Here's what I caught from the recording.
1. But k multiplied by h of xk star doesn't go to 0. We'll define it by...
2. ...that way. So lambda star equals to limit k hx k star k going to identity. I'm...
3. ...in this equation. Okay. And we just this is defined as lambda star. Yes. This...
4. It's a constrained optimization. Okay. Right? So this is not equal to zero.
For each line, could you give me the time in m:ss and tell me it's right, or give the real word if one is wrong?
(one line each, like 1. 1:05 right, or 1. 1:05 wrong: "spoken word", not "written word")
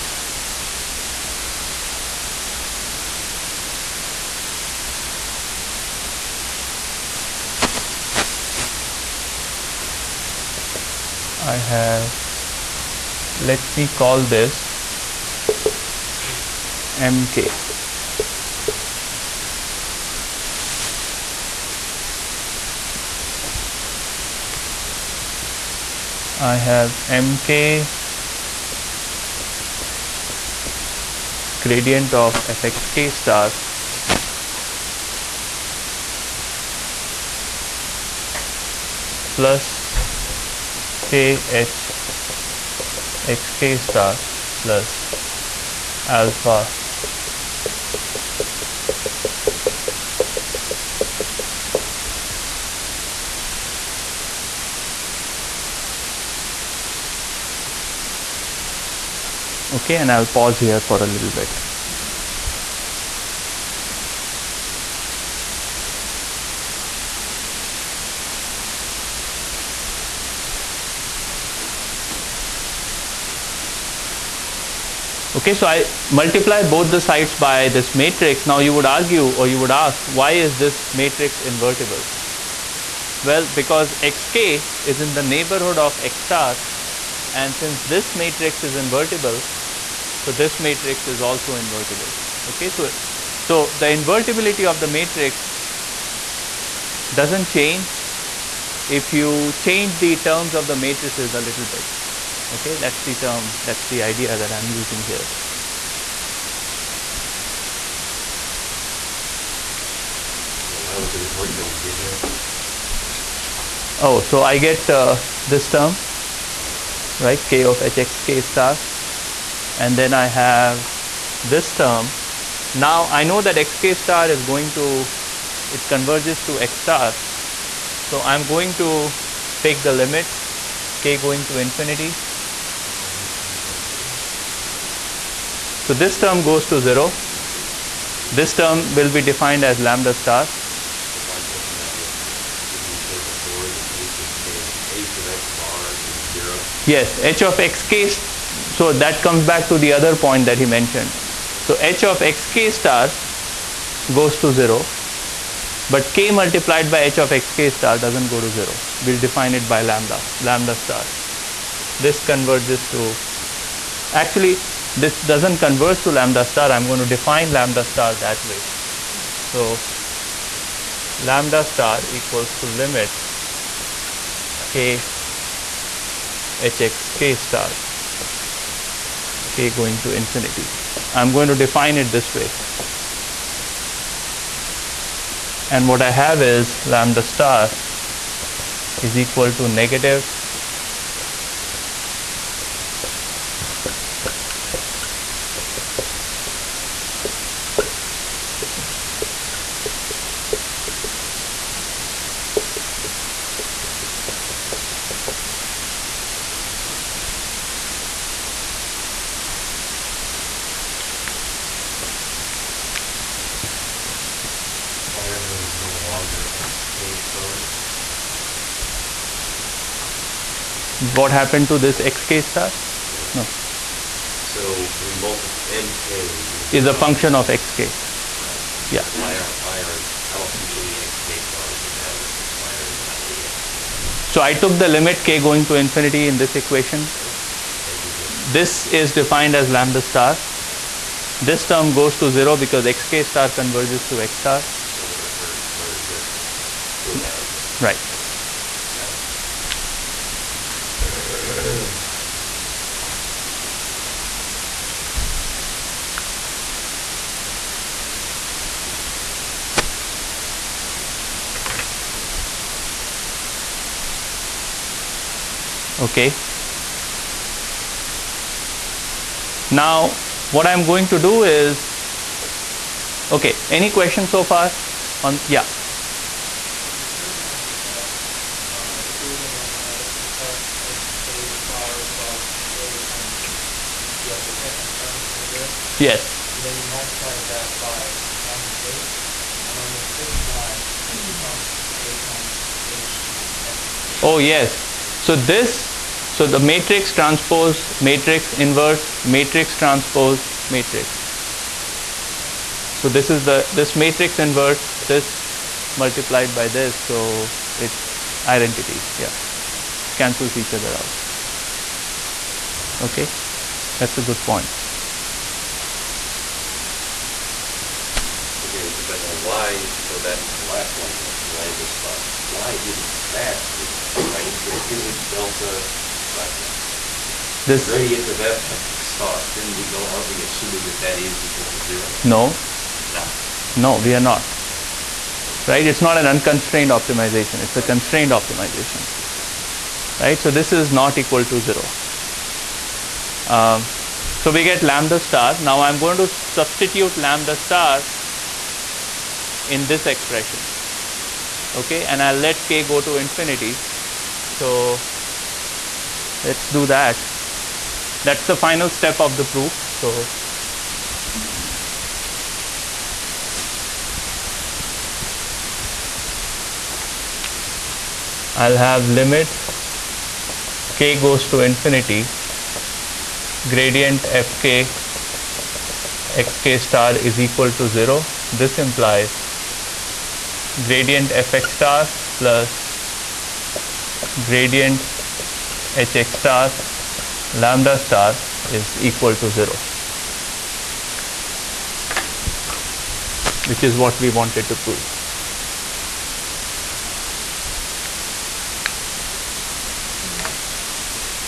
1. 2:35 right
2. 2:48 wrong: "infinity", not "identity"
3. 3:56 right
4. 5:37 right.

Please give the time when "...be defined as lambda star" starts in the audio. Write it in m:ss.
2:19.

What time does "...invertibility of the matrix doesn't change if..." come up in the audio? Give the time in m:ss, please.
1:33.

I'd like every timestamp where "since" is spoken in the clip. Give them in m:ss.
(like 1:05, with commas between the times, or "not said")
1:27.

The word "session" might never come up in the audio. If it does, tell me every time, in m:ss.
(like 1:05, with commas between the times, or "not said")
not said.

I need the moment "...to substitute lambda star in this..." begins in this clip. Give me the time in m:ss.
5:46.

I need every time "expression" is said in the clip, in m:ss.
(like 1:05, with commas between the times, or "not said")
5:50.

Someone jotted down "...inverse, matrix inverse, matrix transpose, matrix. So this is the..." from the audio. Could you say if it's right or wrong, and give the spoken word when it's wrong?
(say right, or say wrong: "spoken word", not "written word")
wrong: "transpose", not "inverse".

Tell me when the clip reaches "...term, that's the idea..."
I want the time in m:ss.
1:43.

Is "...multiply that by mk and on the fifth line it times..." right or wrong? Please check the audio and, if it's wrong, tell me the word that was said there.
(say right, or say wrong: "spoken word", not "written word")
wrong: "becomes", not "times".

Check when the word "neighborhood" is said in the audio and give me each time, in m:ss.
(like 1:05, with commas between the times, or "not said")
1:25.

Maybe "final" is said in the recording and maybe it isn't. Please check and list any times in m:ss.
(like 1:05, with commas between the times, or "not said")
5:58.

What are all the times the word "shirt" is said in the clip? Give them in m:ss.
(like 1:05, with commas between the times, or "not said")
not said.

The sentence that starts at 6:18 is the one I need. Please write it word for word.
This implies gradient fx star plus gradient hx star lambda star is equal to 0 which is what we wanted to prove.